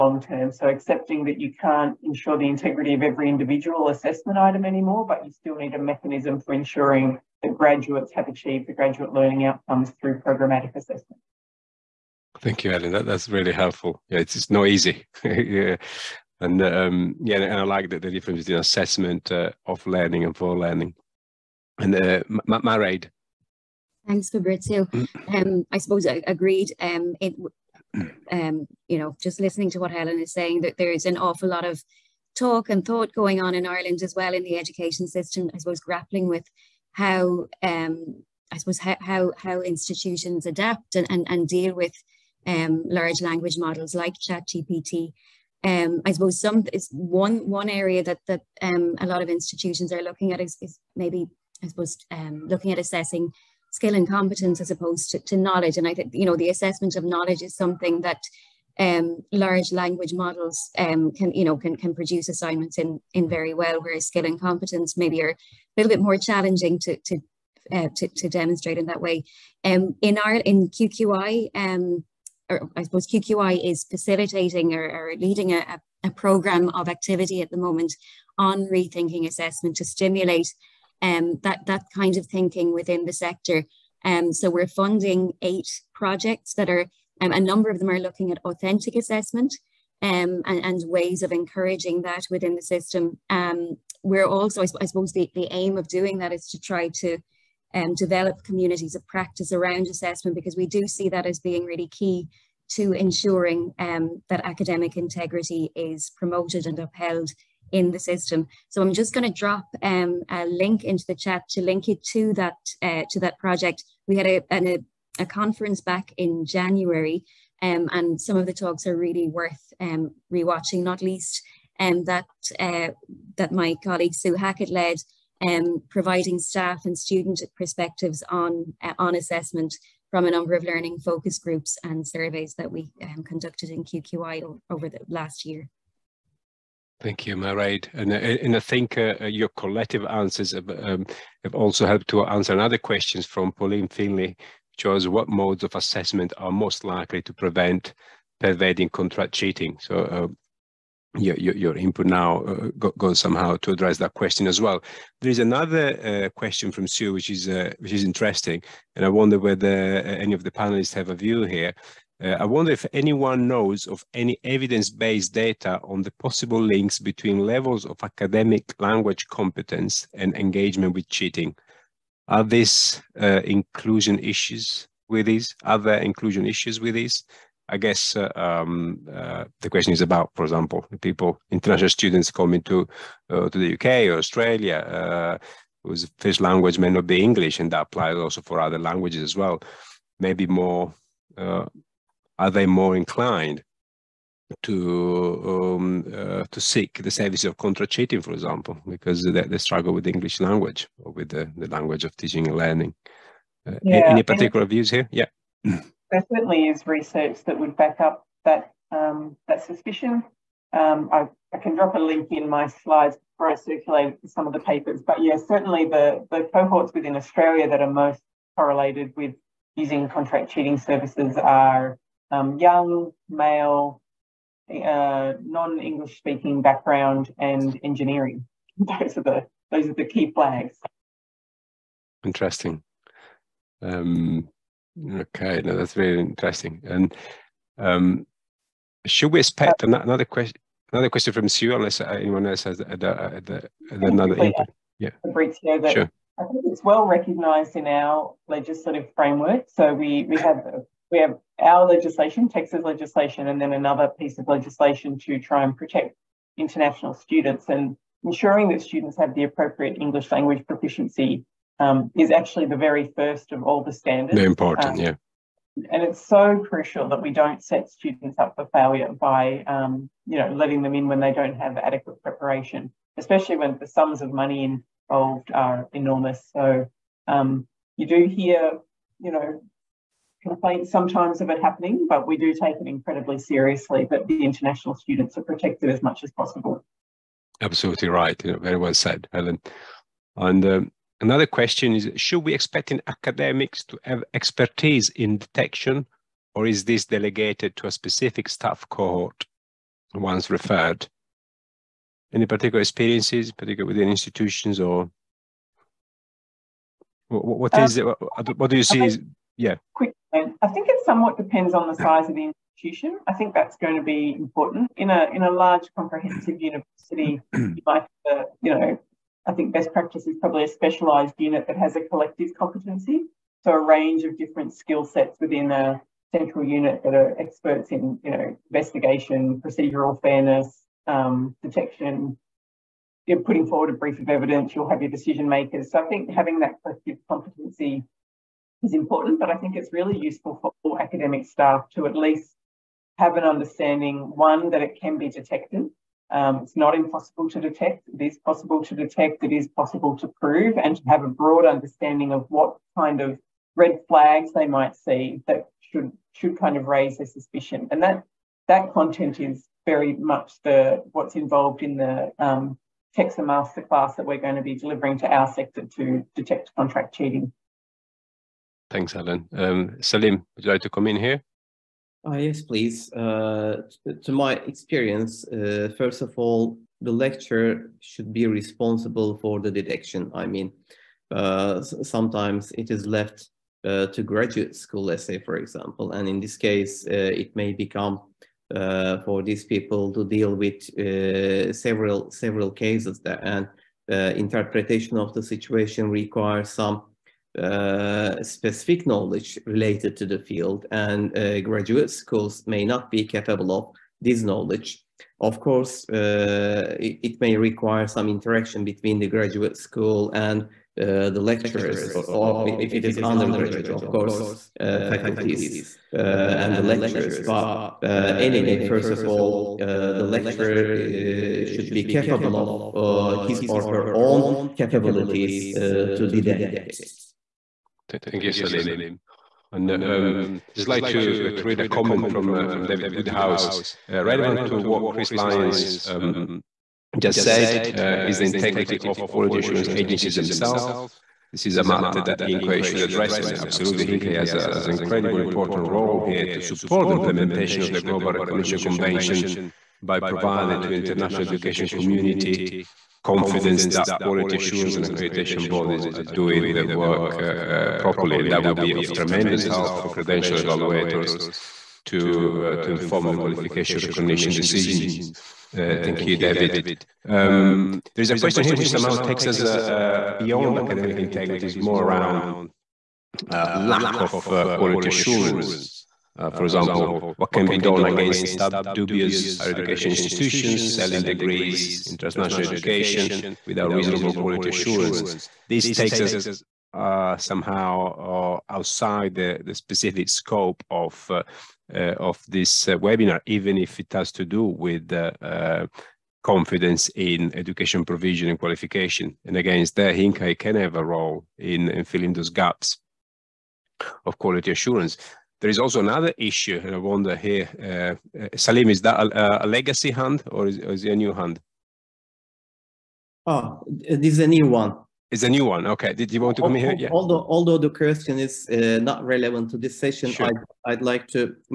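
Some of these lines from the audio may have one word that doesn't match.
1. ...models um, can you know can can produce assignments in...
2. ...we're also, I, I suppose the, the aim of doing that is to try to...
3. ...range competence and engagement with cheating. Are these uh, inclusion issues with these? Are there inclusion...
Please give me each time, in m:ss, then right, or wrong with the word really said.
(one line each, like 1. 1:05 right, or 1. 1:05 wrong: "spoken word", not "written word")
1. 1:00 right
2. 1:34 right
3. 2:48 wrong: "language", not "range".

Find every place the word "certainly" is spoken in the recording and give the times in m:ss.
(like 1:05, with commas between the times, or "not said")
3:26, 3:35.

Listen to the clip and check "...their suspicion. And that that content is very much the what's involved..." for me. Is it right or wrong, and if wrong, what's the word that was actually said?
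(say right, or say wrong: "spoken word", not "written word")
right.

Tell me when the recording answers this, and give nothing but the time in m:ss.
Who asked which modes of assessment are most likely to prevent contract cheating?
2:23.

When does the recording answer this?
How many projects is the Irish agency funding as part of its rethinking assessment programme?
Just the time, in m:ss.
1:25.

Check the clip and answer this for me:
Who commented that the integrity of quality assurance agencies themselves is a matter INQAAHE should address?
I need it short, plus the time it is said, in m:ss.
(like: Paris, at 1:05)
David Woodhouse, at 7:12.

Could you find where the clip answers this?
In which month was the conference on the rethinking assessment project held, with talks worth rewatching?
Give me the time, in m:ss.
1:56.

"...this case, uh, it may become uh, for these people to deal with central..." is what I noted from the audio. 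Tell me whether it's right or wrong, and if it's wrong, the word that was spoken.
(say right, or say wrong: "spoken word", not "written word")
wrong: "several", not "central".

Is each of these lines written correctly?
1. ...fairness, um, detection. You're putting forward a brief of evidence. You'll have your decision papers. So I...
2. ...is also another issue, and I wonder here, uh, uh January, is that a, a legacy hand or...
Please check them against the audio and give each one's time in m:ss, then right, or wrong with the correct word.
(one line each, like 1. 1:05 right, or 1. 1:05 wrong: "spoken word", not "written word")
1. 5:30 wrong: "makers", not "papers"
2. 8:25 wrong: "Salim", not "January".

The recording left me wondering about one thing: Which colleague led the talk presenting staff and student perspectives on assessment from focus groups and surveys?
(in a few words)
Sue Hackett.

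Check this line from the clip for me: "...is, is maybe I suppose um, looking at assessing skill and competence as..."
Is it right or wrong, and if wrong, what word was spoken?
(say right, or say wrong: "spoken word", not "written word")
right.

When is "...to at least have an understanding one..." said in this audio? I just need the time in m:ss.
5:41.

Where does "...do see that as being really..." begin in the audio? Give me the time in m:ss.
1:40.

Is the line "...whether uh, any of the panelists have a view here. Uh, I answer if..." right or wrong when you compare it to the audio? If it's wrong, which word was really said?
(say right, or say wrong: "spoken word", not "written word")
wrong: "wonder", not "answer".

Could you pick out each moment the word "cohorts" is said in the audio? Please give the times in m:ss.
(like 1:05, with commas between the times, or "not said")
3:36, 4:58.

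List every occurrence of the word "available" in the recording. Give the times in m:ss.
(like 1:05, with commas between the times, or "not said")
not said.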